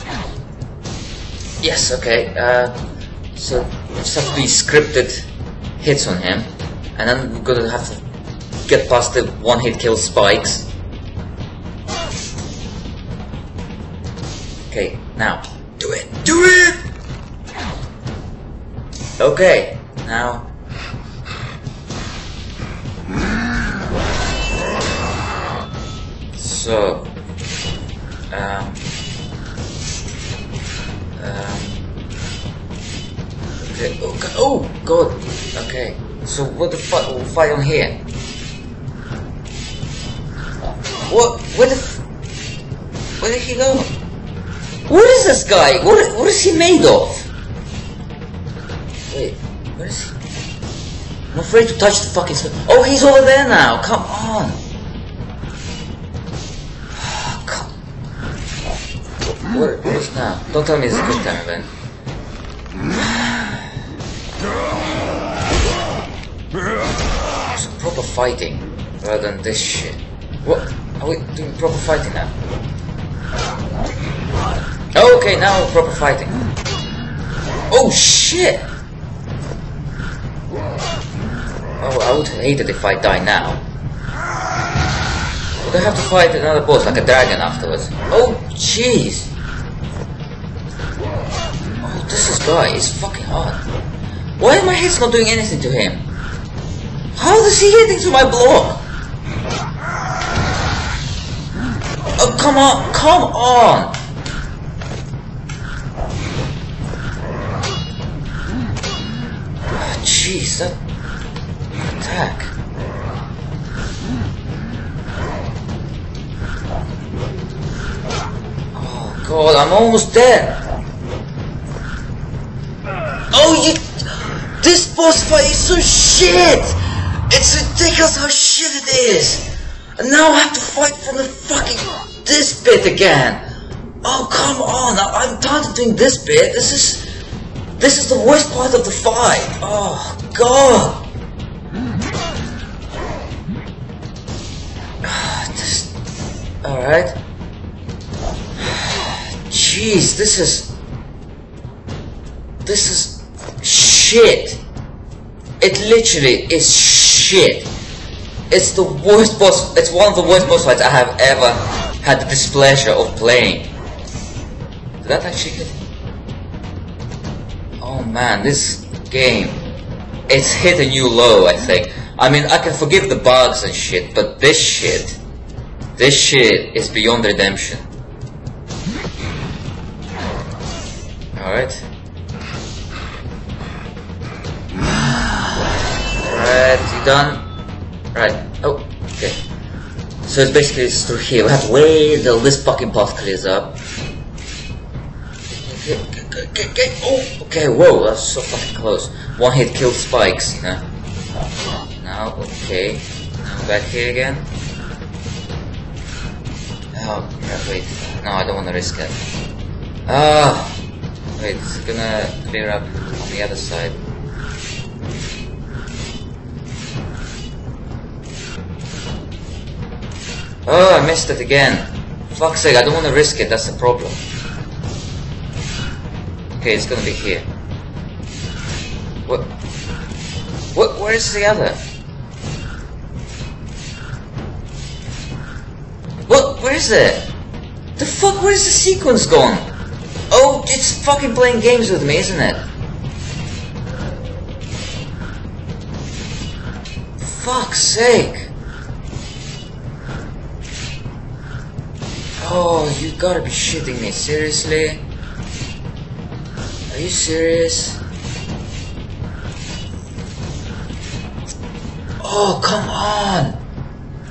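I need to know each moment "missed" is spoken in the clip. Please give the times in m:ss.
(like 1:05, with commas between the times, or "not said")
3:41.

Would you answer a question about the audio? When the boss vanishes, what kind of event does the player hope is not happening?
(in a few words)
a quick time event.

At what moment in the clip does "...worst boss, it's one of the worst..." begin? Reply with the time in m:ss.
2:38.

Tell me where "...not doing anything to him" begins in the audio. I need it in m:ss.
1:35.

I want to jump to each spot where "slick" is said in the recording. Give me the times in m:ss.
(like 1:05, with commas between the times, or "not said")
not said.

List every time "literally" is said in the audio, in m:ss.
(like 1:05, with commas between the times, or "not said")
2:35.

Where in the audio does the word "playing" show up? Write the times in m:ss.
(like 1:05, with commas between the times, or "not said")
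2:43, 4:01.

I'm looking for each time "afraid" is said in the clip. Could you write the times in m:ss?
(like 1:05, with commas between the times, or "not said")
0:51.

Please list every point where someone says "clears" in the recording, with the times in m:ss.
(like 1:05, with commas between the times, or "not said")
3:13, 3:32.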